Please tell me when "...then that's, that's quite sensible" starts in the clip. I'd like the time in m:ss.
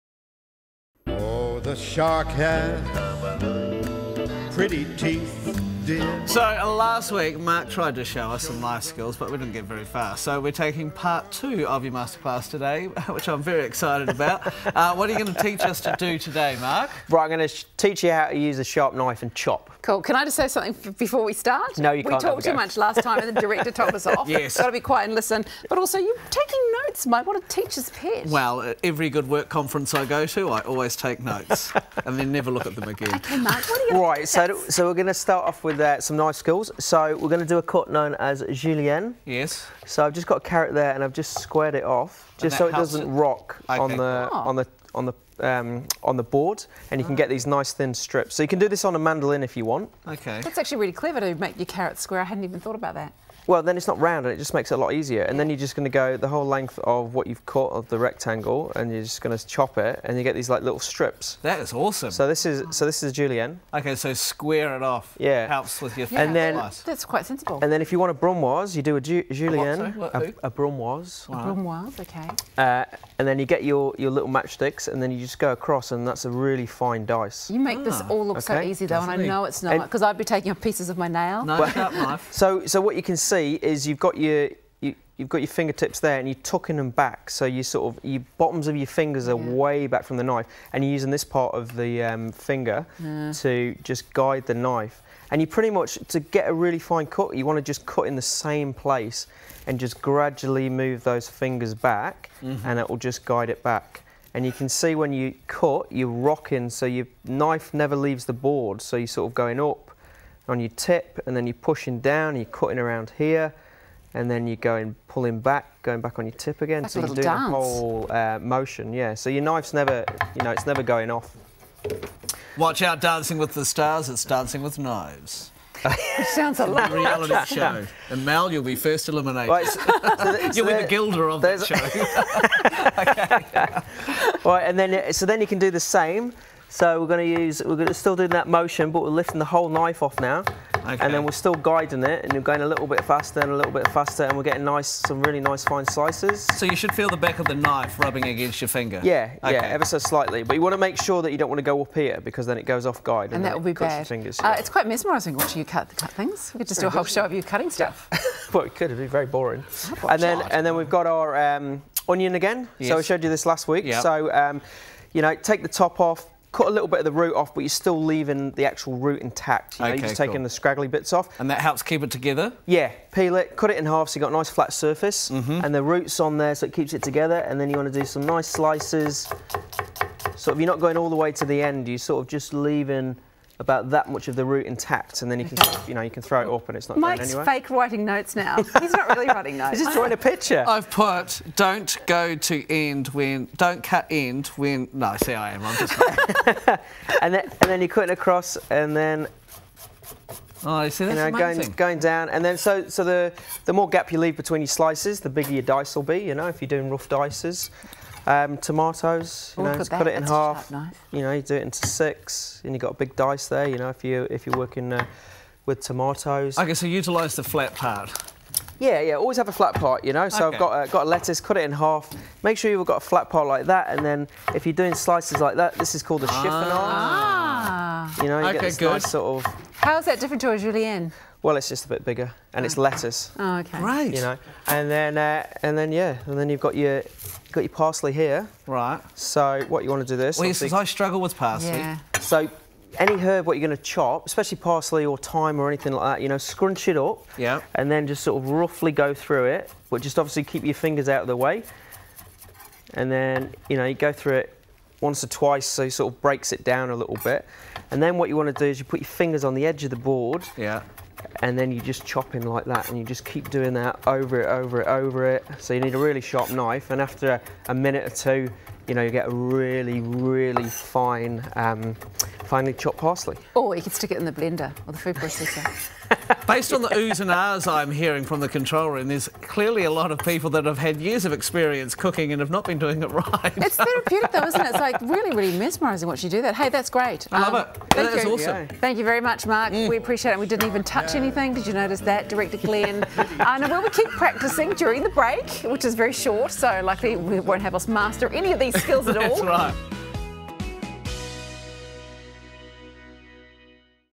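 1:06.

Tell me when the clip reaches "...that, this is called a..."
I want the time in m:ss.
3:45.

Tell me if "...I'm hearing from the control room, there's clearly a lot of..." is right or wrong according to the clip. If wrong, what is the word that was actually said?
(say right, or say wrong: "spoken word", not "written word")
right.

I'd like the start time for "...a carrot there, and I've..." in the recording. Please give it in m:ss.
0:40.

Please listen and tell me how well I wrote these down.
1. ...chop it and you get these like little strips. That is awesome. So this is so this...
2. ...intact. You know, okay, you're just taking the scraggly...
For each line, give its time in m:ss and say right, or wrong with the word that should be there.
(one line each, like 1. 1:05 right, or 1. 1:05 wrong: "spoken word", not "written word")
1. 0:59 right
2. 2:49 right.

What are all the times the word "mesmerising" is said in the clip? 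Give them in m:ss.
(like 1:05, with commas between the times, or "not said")
2:34, 4:45.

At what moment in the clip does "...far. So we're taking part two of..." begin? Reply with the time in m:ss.
0:09.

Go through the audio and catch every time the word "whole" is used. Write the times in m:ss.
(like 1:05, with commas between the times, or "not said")
0:56, 1:57, 2:19, 2:36.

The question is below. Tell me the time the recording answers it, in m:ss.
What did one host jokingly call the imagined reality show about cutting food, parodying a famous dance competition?
2:04.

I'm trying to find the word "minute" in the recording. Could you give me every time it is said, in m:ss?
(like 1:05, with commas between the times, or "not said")
4:27.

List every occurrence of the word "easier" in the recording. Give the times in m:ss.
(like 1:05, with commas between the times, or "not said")
0:54.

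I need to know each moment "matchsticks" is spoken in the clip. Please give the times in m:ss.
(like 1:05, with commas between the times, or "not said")
1:14.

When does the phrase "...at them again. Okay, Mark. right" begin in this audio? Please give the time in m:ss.
0:32.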